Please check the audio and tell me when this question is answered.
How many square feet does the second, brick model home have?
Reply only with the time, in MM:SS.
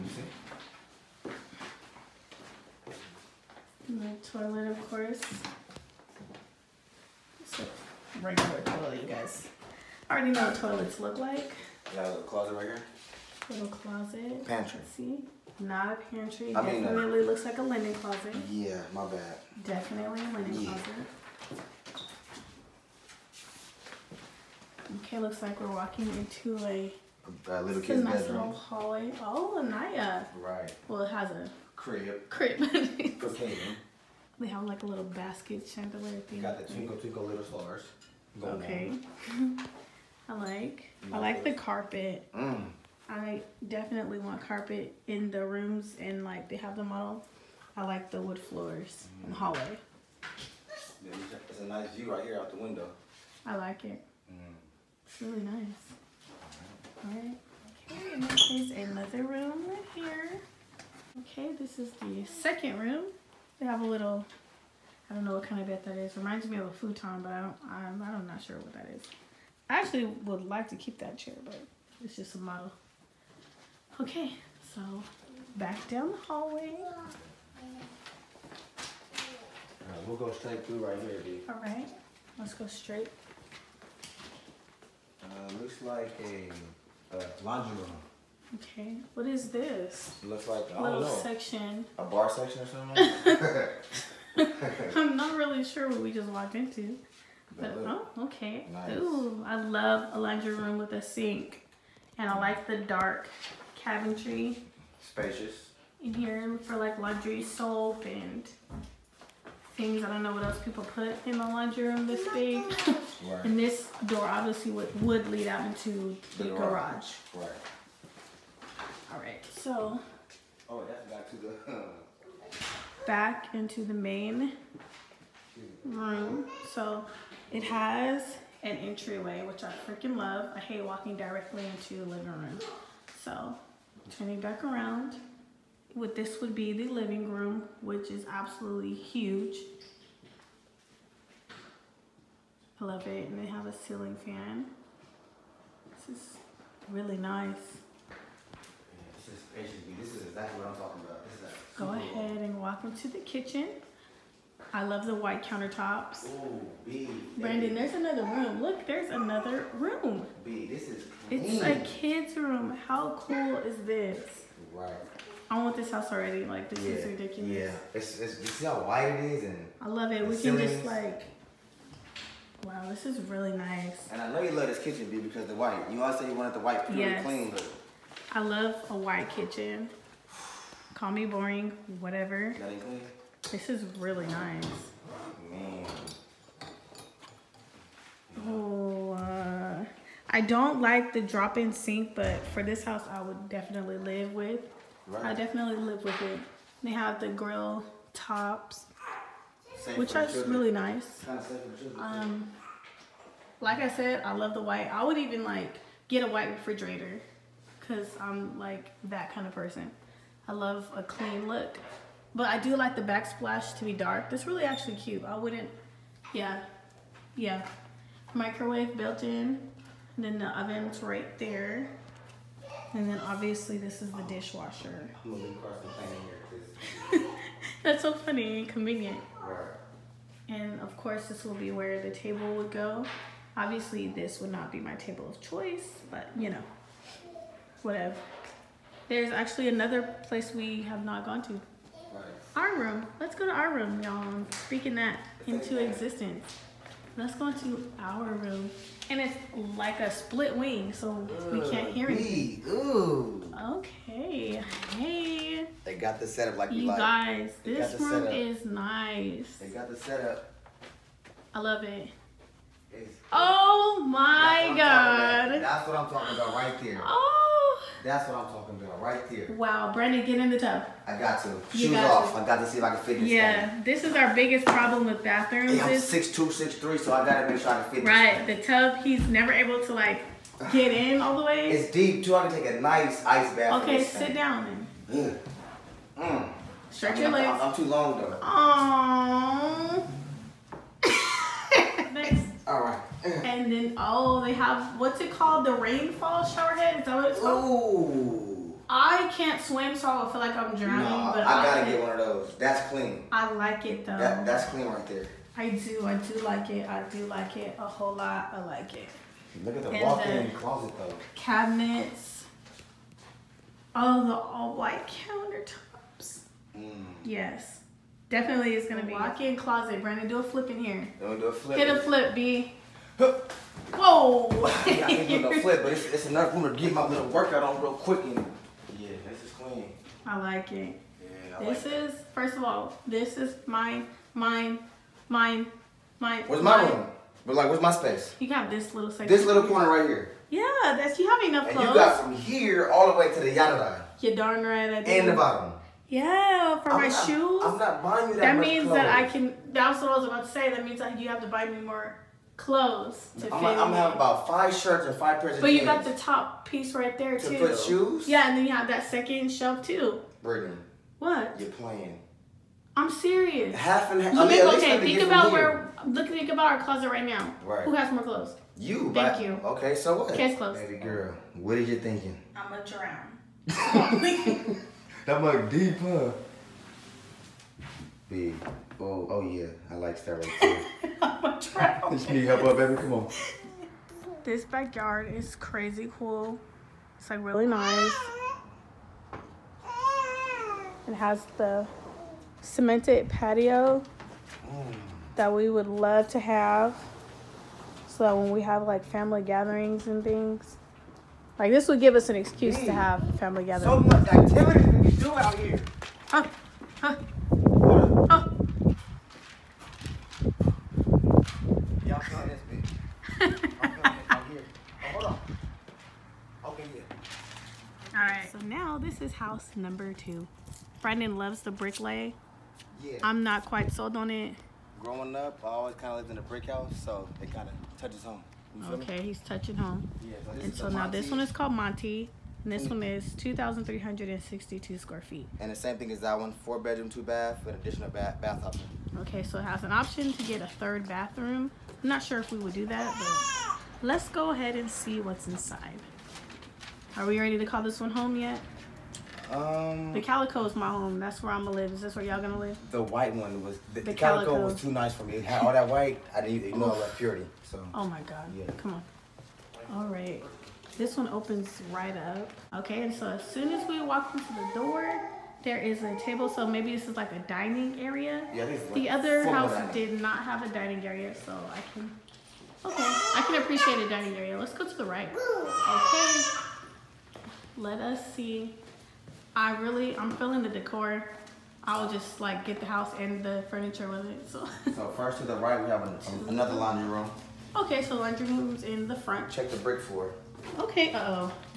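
07:13.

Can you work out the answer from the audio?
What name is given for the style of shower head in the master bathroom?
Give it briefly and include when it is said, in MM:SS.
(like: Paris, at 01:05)
rainfall shower head, at 04:55.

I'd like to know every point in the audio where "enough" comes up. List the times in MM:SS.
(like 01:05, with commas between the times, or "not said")
05:26, 05:41.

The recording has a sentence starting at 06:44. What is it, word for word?
So much activity we can do out here.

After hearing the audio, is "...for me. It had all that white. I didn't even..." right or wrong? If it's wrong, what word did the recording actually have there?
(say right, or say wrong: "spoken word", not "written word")
right.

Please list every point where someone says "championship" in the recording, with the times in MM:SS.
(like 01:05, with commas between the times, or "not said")
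not said.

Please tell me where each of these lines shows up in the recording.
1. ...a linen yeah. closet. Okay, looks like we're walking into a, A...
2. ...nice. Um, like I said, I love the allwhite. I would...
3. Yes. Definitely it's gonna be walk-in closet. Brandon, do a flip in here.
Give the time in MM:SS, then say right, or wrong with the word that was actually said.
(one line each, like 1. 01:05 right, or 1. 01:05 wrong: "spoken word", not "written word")
1. 00:20 right
2. 03:20 wrong: "white", not "allwhite"
3. 05:17 right.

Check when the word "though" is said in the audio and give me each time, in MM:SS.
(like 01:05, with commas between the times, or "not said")
04:48, 05:04, 05:10.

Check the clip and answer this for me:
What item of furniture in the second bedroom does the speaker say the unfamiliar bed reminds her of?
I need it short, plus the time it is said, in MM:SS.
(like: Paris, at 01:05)
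futon, at 01:06.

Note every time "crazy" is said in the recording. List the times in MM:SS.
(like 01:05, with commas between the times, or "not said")
06:25.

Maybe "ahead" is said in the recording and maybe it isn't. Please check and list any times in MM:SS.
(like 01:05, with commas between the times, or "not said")
02:31, 07:24.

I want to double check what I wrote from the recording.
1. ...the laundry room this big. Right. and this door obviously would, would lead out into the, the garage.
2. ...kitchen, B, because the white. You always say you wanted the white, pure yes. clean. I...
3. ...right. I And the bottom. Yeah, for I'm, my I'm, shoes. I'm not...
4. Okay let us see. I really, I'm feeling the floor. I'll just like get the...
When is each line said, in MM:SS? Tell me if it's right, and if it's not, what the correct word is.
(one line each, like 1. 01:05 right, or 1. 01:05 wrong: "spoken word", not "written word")
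1. 01:51 right
2. 02:54 right
3. 05:44 right
4. 07:55 wrong: "decor", not "floor".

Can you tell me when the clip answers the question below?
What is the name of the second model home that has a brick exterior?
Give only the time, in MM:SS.
07:11.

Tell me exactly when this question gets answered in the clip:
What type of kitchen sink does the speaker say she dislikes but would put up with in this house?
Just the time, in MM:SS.
03:11.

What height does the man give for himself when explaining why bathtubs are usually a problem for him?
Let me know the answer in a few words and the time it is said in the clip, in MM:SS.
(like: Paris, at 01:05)
6'2", at 04:35.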